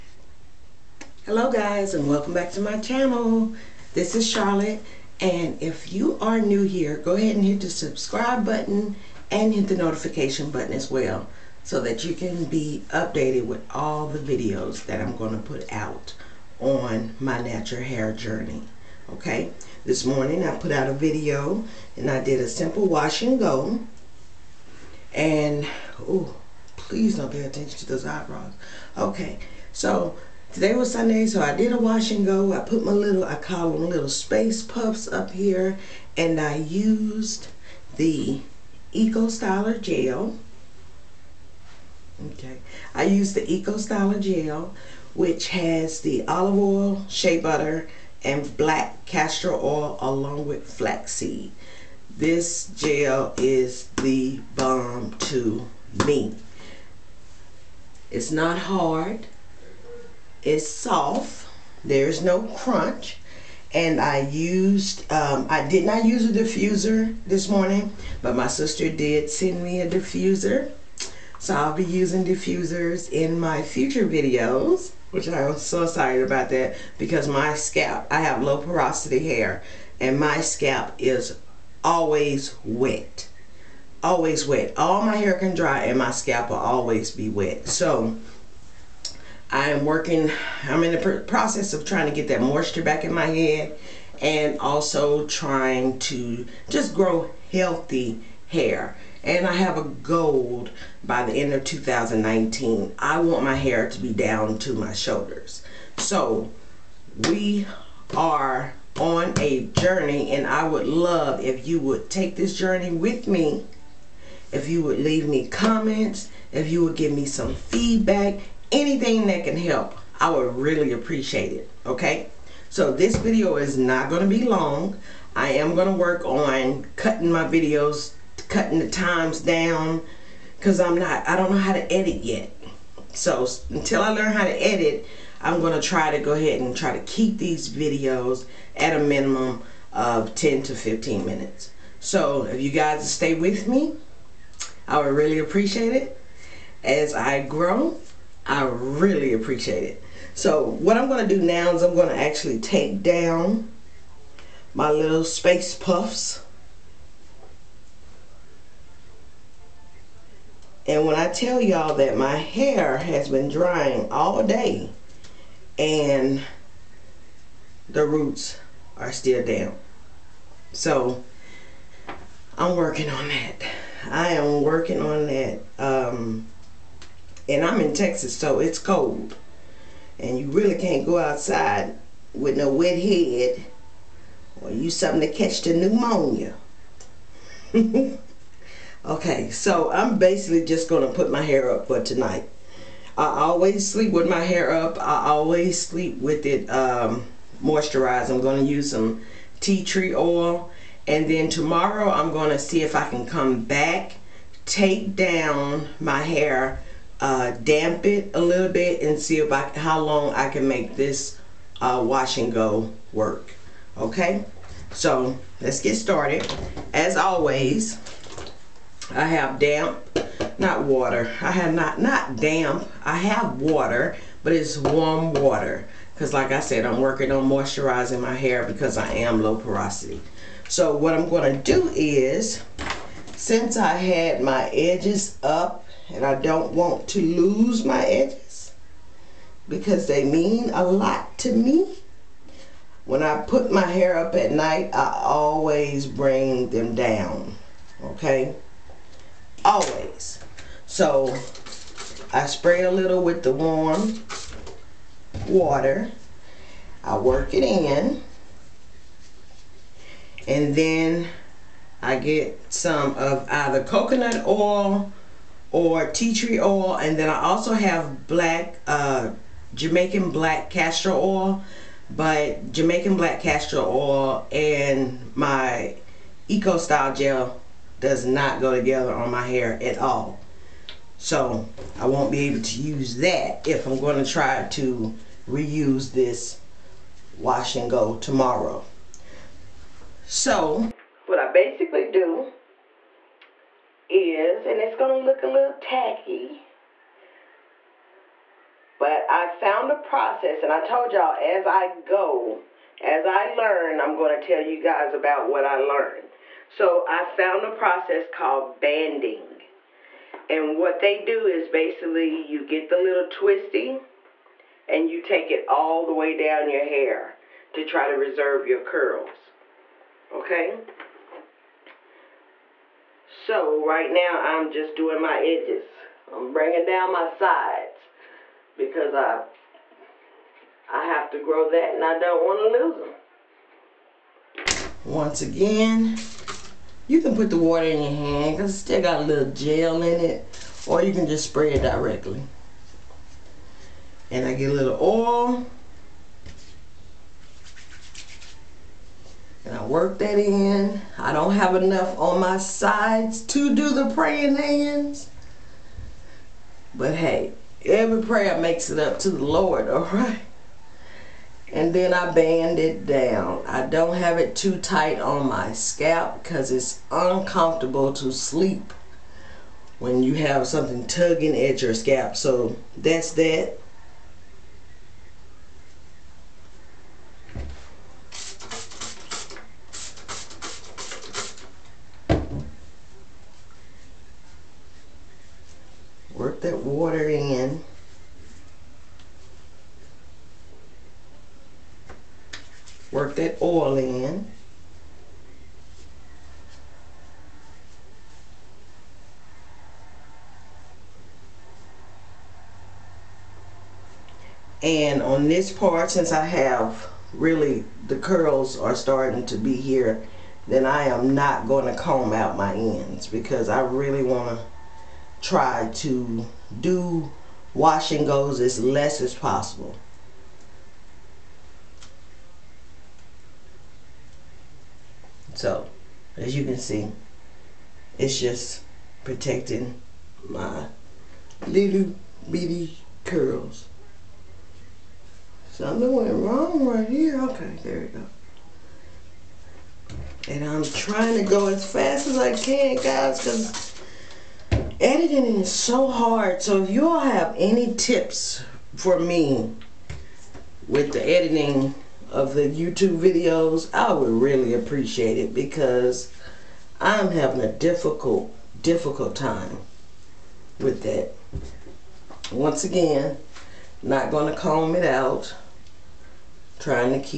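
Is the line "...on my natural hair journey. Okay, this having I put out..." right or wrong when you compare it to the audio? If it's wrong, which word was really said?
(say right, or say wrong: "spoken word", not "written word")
wrong: "morning", not "having".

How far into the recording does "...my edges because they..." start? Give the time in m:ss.
3:57.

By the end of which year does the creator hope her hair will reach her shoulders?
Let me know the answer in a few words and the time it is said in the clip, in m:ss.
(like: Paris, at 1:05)
2019, at 1:41.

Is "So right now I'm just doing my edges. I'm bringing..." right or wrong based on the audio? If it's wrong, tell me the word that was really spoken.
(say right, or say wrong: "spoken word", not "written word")
right.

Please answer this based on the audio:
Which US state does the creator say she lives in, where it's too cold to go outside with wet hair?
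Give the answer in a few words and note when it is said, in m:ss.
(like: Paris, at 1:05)
Texas, at 2:57.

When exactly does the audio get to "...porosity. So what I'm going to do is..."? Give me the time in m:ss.
3:49.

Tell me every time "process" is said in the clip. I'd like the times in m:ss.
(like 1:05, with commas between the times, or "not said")
1:31, 4:59, 5:07.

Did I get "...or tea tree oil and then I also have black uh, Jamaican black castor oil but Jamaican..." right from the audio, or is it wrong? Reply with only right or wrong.
right.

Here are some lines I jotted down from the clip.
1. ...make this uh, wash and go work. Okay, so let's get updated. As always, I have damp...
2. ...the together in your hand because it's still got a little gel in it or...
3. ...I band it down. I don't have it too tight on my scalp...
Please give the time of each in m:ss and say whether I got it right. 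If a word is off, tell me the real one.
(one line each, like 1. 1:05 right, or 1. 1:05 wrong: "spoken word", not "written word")
1. 3:30 wrong: "started", not "updated"
2. 5:37 wrong: "water", not "together"
3. 6:02 right.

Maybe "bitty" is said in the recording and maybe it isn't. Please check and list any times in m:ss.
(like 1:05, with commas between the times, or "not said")
7:12.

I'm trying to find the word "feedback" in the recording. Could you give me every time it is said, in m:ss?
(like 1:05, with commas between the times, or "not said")
1:57.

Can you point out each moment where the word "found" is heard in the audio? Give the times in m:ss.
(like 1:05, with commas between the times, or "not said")
4:59, 5:07.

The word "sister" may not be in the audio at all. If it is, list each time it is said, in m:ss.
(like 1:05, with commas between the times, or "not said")
1:08.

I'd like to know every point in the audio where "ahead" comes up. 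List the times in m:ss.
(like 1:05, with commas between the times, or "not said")
0:07, 2:16.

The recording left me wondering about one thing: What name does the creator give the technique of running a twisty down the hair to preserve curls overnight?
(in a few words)
banding.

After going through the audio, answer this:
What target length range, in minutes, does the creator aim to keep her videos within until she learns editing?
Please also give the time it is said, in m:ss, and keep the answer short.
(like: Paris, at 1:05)
10 to 15 minutes, at 2:20.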